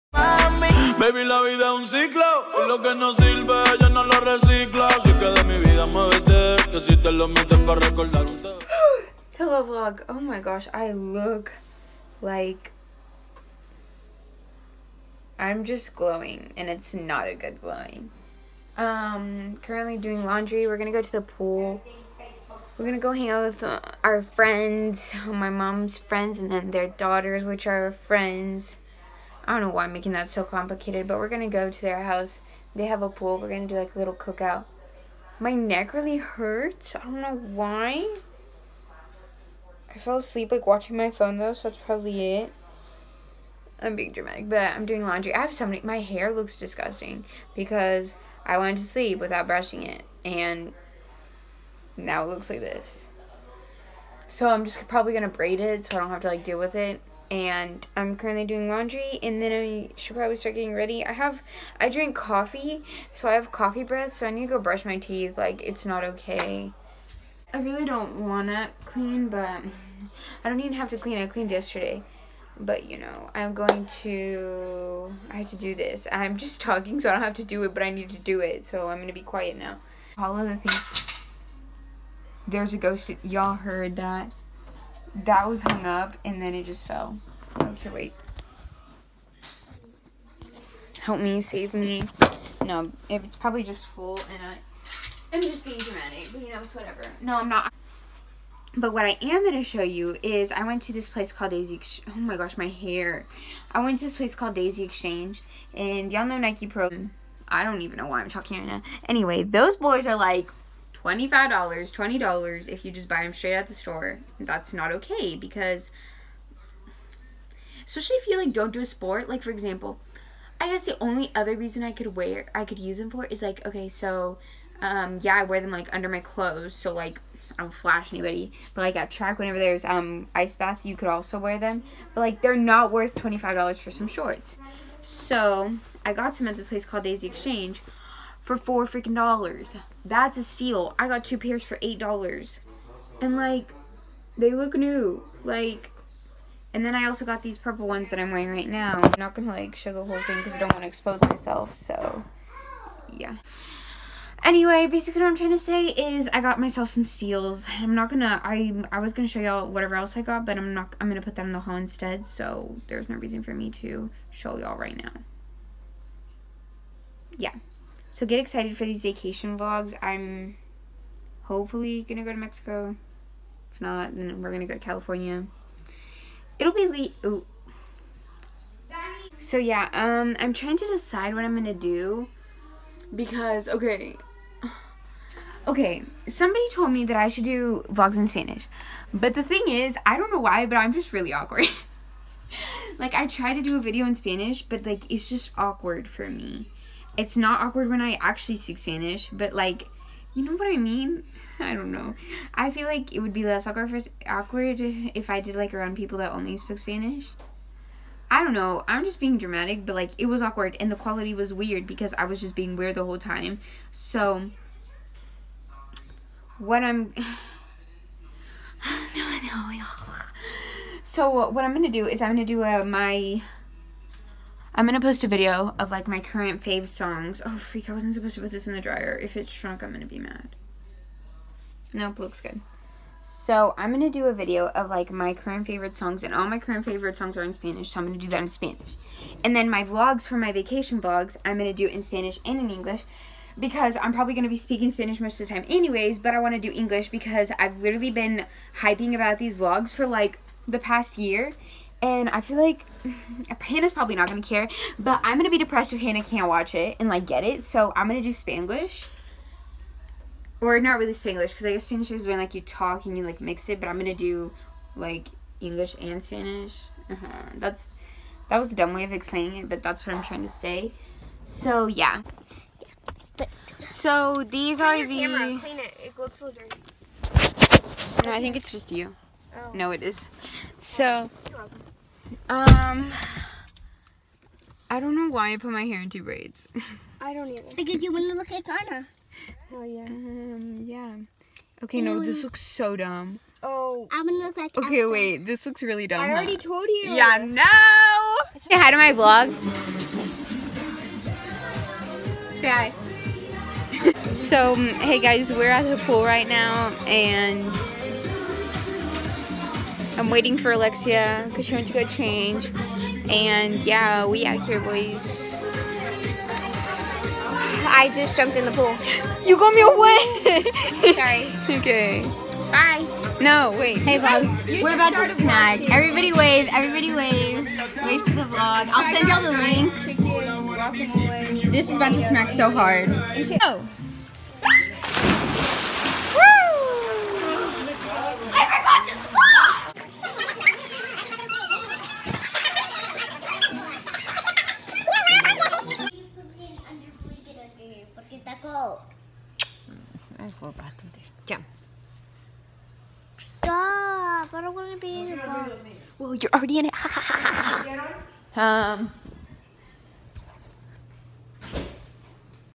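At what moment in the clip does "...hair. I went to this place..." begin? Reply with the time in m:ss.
1:42.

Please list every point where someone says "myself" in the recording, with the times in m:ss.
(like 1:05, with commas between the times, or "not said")
2:31, 2:36.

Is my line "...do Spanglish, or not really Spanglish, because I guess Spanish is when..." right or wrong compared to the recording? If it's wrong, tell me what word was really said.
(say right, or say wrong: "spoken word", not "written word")
right.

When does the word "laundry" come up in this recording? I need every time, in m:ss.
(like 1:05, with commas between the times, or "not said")
0:20, 0:45, 0:58.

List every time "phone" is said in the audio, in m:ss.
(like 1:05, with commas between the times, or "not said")
0:41.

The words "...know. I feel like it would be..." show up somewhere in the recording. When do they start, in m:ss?
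3:21.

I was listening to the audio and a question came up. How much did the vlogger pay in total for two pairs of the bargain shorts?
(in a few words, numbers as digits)
$8.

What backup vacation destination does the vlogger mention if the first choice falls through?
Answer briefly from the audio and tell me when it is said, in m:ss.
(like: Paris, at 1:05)
California, at 2:54.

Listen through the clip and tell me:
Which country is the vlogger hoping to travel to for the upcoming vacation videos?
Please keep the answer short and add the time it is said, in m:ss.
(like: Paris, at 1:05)
Mexico, at 2:52.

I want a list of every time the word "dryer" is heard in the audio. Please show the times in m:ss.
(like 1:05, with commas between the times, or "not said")
3:48.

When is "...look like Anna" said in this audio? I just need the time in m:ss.
4:48.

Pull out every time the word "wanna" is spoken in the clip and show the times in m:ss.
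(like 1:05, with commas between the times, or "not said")
1:08, 4:06.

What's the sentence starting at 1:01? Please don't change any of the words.
I have I drink coffee, so I have coffee breath, so I need to go brush my teeth.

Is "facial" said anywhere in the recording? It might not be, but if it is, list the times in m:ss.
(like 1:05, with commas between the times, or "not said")
not said.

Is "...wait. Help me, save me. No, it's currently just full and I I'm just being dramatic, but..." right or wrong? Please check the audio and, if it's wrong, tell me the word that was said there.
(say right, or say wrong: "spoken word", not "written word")
wrong: "probably", not "currently".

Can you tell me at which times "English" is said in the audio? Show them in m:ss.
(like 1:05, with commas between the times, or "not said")
4:02, 4:06, 4:25.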